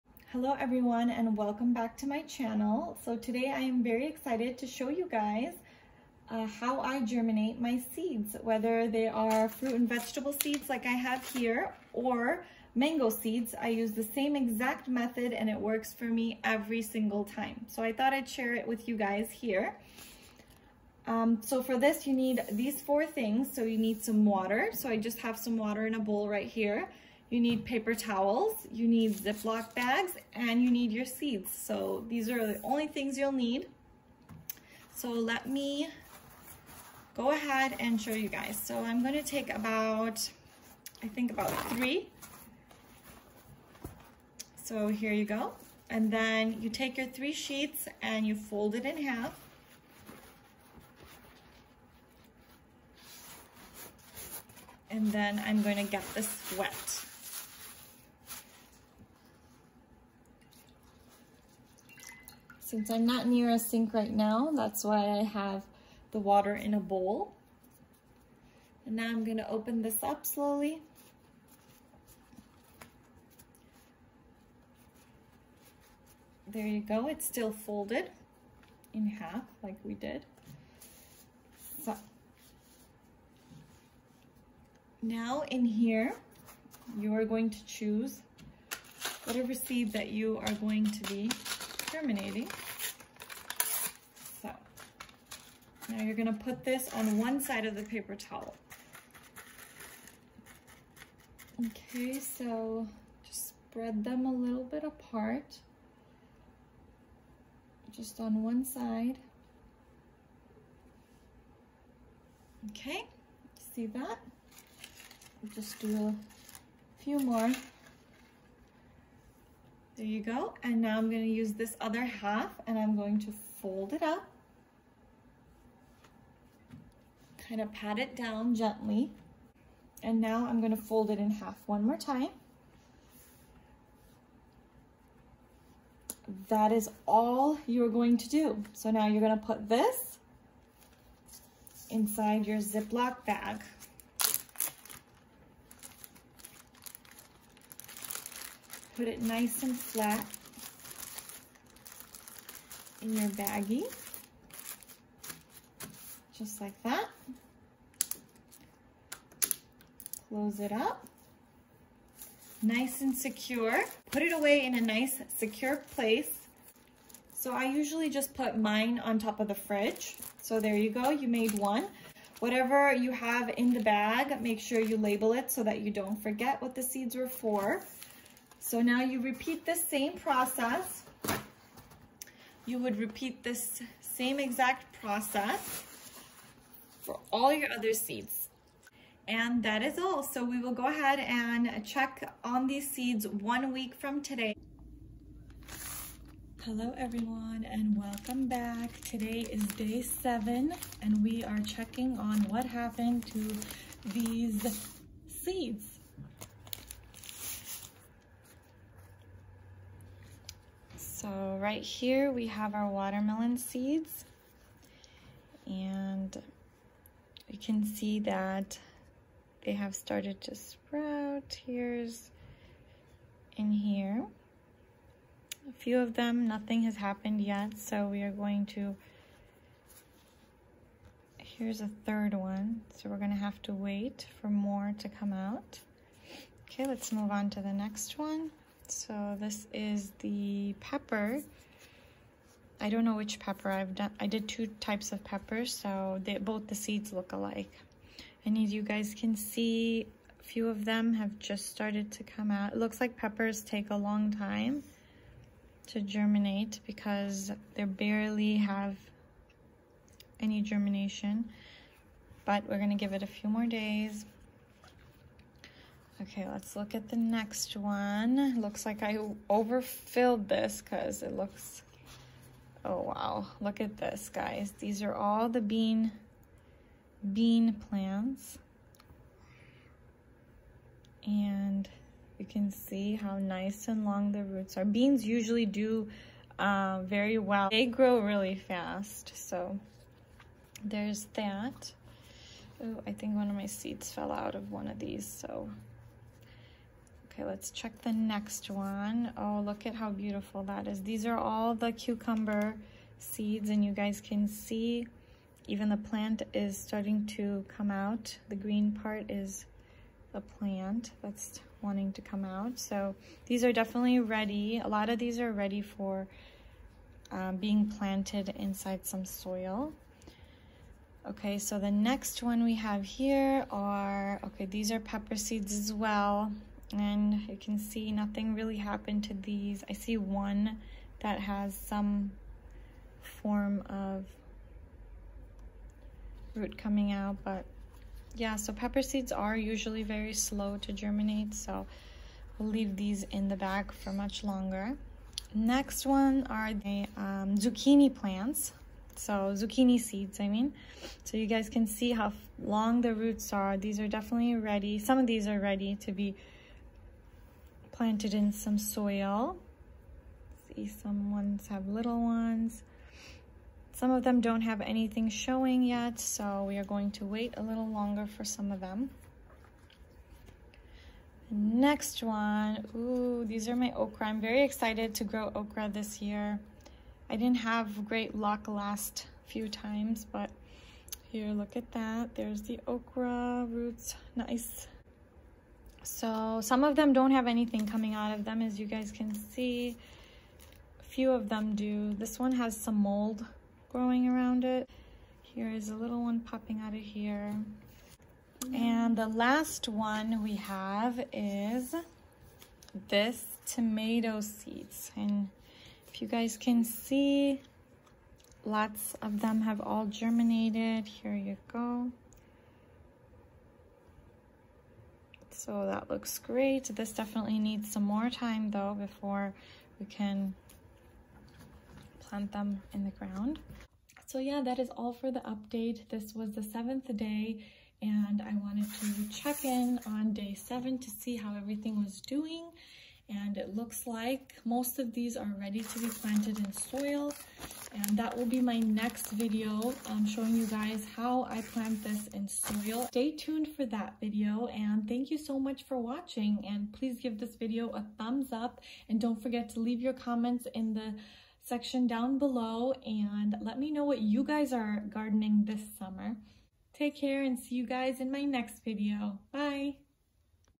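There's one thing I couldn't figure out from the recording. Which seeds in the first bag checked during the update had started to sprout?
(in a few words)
Watermelon.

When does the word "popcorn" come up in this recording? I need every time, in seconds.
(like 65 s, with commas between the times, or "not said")
not said.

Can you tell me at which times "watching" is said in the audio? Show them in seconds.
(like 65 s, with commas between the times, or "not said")
445 s.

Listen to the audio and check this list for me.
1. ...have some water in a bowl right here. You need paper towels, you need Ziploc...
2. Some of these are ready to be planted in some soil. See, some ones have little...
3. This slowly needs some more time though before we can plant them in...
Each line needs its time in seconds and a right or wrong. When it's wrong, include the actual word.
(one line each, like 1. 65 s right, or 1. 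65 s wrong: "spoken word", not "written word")
1. 25 s right
2. 354 s right
3. 416 s wrong: "definitely", not "slowly".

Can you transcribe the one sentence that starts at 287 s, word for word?
They grow really fast, so there's that.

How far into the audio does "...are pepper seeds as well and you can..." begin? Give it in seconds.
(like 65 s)
324 s.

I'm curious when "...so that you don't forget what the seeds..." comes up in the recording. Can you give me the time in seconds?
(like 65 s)
175 s.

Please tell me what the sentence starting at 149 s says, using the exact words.
put it nice and flat in your baggie, just like that.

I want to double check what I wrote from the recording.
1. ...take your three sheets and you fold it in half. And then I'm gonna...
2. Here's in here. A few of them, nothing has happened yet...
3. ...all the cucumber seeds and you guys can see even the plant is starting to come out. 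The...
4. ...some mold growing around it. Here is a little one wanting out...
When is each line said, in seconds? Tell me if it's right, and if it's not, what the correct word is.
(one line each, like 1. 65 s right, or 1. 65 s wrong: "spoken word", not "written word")
1. 46 s right
2. 221 s right
3. 301 s right
4. 392 s wrong: "popping", not "wanting".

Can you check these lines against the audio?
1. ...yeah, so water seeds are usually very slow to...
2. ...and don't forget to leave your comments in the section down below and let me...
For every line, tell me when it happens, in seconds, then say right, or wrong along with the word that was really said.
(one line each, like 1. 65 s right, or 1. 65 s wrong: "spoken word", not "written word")
1. 338 s wrong: "pepper", not "water"
2. 449 s right.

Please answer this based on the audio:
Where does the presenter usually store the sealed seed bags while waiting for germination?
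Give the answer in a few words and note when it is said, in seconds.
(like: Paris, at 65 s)
On top of the fridge, at 168 s.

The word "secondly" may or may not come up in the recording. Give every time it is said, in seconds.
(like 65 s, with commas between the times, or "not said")
not said.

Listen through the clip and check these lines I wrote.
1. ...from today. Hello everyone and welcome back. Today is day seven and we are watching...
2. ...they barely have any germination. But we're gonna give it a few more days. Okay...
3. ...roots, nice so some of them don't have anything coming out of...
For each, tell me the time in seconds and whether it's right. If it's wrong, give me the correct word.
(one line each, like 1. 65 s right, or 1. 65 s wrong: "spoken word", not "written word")
1. 193 s wrong: "checking", not "watching"
2. 257 s right
3. 383 s right.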